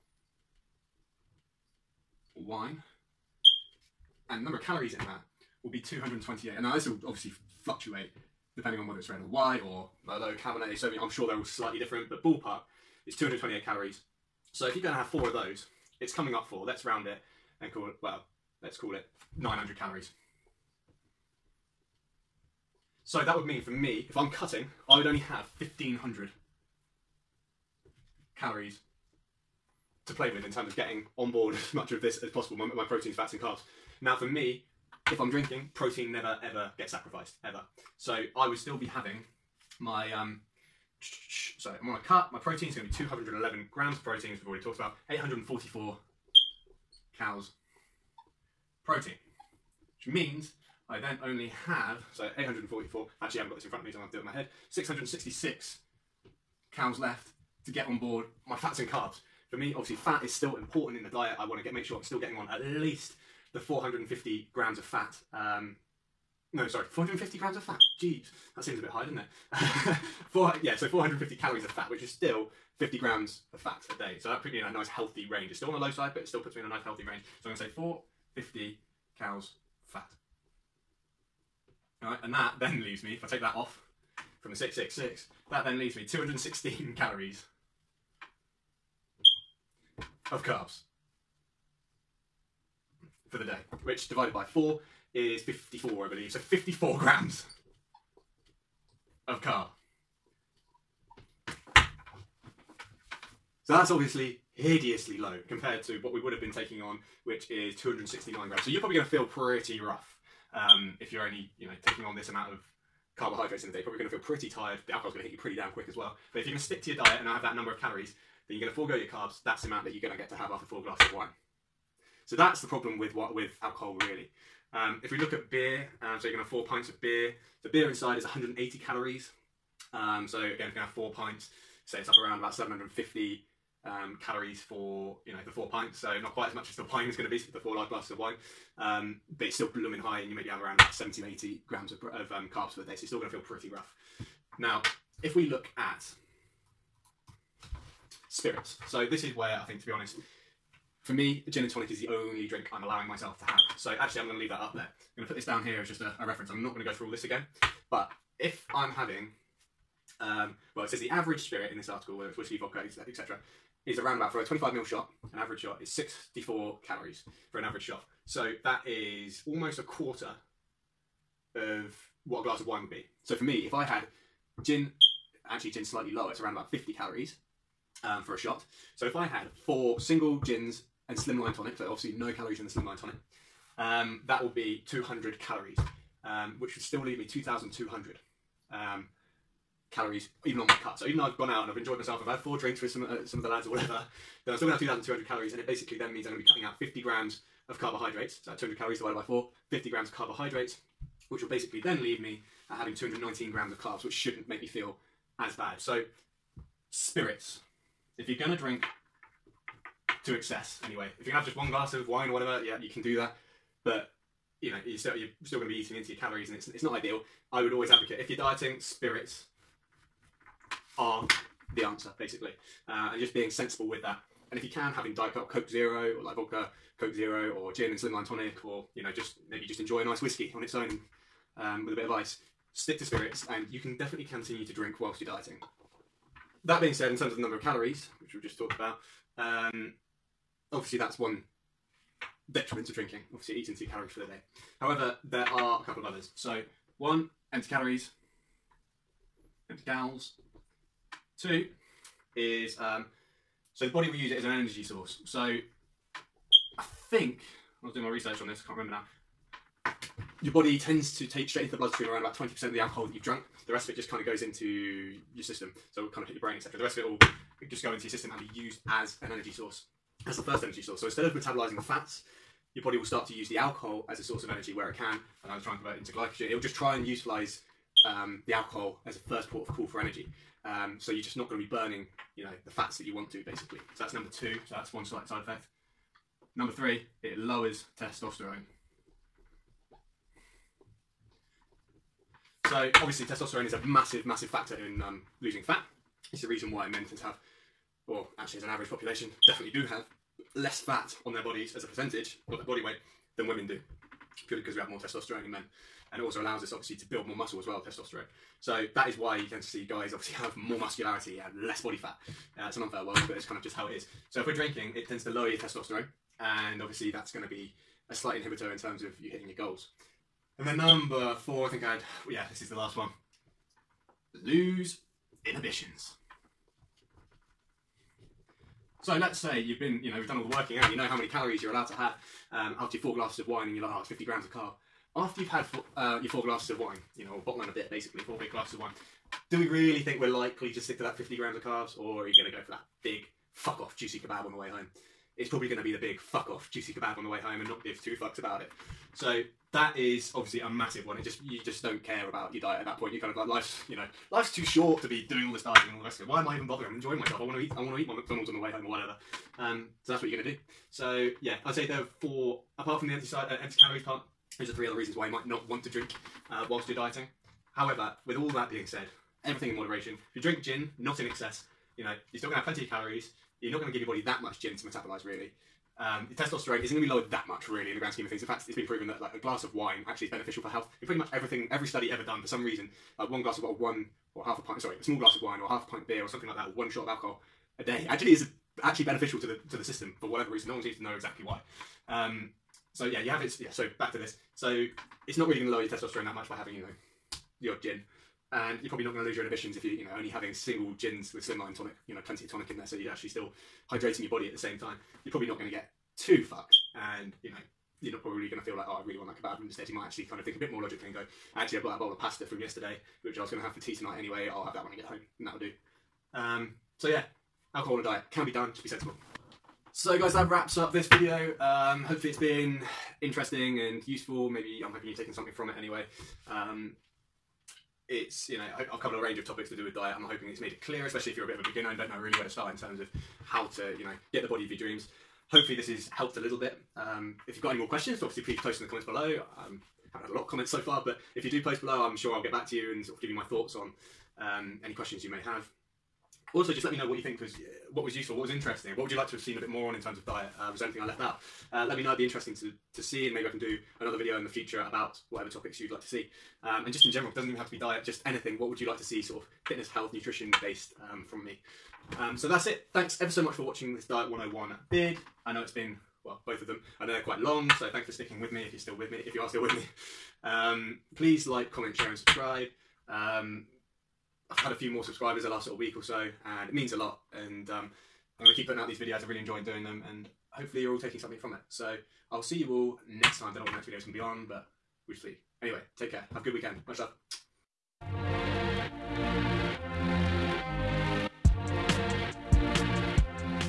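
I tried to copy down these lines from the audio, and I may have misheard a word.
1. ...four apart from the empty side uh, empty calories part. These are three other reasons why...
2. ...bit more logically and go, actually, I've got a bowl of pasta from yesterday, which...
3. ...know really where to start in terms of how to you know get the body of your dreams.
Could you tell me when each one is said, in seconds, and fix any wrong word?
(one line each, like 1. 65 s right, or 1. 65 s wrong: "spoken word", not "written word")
1. 362 s right
2. 410 s right
3. 432 s right.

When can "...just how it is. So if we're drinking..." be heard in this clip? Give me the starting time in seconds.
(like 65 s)
313 s.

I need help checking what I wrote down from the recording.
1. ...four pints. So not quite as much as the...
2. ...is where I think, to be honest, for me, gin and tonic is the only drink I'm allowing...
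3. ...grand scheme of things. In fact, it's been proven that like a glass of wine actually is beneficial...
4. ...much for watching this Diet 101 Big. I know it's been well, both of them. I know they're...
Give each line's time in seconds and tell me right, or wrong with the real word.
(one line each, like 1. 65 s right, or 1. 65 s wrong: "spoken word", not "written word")
1. 135 s right
2. 149 s right
3. 377 s right
4. 463 s right.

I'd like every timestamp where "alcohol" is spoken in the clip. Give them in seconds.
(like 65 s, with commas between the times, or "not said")
114 s, 123 s, 262 s, 273 s, 278 s, 387 s, 417 s.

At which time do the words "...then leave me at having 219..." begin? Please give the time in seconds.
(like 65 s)
201 s.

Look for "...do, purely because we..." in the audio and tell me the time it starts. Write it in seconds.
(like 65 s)
303 s.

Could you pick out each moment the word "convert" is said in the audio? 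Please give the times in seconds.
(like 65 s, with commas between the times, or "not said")
275 s.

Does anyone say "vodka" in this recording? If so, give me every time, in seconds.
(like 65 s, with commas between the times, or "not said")
162 s, 226 s.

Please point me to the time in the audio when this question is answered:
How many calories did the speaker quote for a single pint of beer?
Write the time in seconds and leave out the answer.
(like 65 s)
128 s.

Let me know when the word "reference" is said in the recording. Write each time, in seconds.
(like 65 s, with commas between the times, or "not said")
156 s.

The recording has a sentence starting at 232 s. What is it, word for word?
Stick to spirits and you can definitely continue to drink whilst you're dieting.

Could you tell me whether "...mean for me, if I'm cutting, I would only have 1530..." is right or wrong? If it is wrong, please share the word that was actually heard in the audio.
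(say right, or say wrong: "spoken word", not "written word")
wrong: "1500", not "1530".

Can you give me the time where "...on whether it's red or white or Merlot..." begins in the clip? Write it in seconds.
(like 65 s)
8 s.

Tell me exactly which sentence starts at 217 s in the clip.
I would always advocate if you're dieting, spirits are the answer basically, uh, and just being sensible with that.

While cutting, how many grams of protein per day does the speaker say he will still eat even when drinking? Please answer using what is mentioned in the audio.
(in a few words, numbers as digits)
211.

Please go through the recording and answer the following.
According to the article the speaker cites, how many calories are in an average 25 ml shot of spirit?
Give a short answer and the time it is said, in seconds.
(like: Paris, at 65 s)
64, at 165 s.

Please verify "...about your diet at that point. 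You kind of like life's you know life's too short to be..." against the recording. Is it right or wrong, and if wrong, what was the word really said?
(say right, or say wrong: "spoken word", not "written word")
right.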